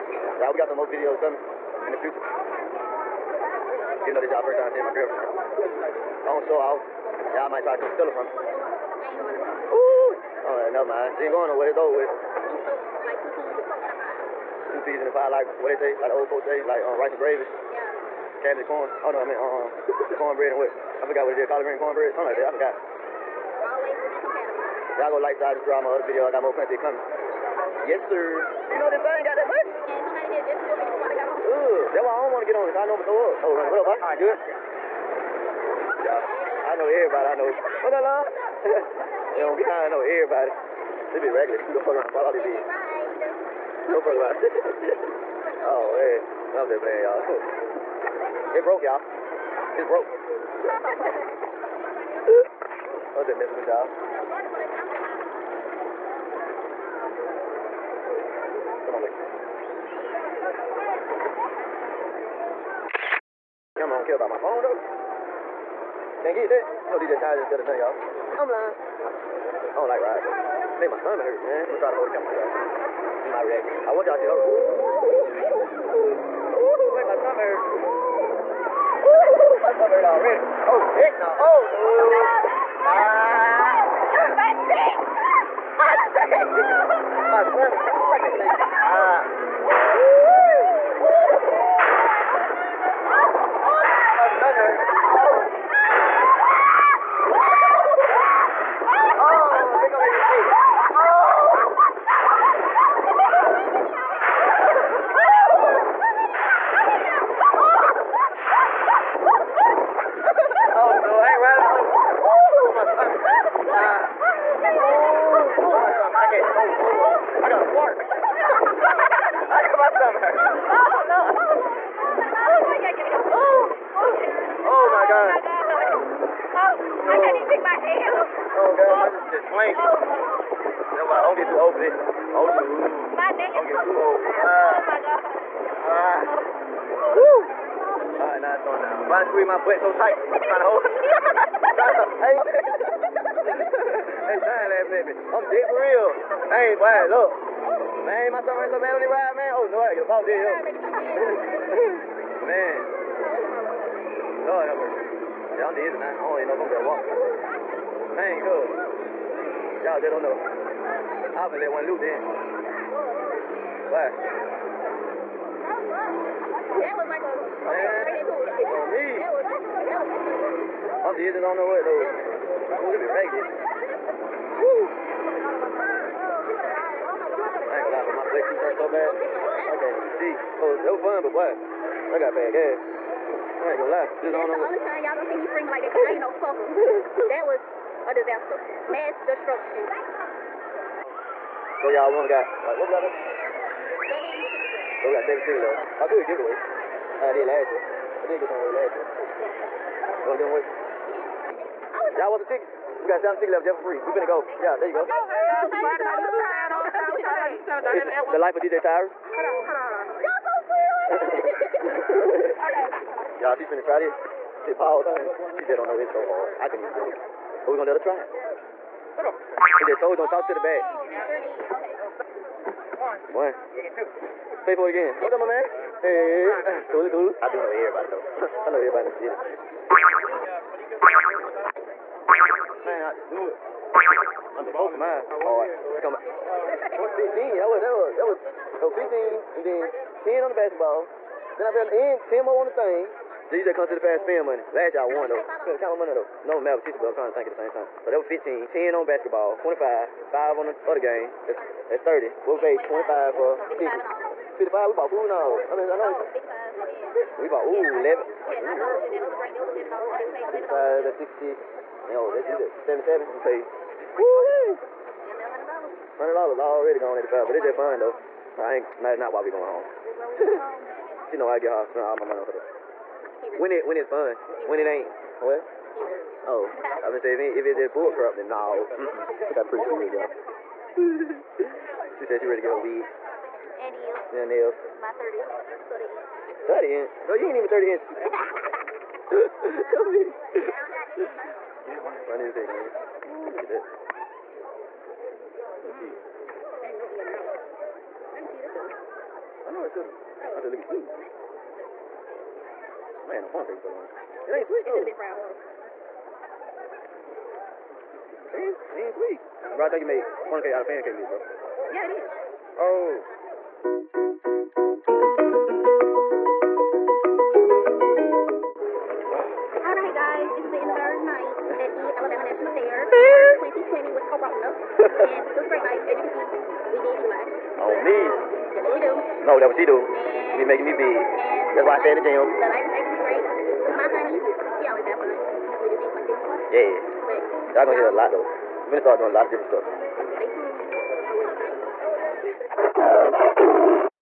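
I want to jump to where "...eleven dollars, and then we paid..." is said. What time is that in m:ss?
4:19.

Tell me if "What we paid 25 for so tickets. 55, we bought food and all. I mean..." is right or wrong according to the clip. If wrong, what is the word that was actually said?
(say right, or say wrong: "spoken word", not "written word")
right.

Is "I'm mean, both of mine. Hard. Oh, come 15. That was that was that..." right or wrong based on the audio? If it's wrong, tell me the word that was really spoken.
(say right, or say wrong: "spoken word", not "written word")
right.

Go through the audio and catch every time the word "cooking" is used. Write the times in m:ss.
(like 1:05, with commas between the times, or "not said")
5:03.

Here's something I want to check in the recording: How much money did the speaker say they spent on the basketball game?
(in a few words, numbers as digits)
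10.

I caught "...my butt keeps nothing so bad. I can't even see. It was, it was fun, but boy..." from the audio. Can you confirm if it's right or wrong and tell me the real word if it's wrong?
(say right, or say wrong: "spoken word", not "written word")
wrong: "hurting", not "nothing".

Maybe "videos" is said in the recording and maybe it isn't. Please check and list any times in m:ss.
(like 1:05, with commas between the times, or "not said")
0:00, 0:26.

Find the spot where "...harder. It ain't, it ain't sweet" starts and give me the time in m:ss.
5:05.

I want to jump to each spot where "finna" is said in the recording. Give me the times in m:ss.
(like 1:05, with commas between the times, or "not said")
3:24, 3:33.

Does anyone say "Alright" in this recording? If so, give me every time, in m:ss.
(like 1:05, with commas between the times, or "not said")
0:10.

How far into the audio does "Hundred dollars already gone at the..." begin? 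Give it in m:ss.
4:26.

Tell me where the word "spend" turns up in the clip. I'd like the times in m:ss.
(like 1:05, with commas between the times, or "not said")
4:04, 4:31.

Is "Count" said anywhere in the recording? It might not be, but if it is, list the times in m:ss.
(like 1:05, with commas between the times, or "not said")
4:05.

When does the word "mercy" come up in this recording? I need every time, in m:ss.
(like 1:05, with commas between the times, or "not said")
2:34.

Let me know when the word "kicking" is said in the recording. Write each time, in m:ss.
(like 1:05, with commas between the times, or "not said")
not said.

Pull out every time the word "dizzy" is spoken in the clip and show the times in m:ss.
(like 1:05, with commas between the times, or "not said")
2:35, 2:51.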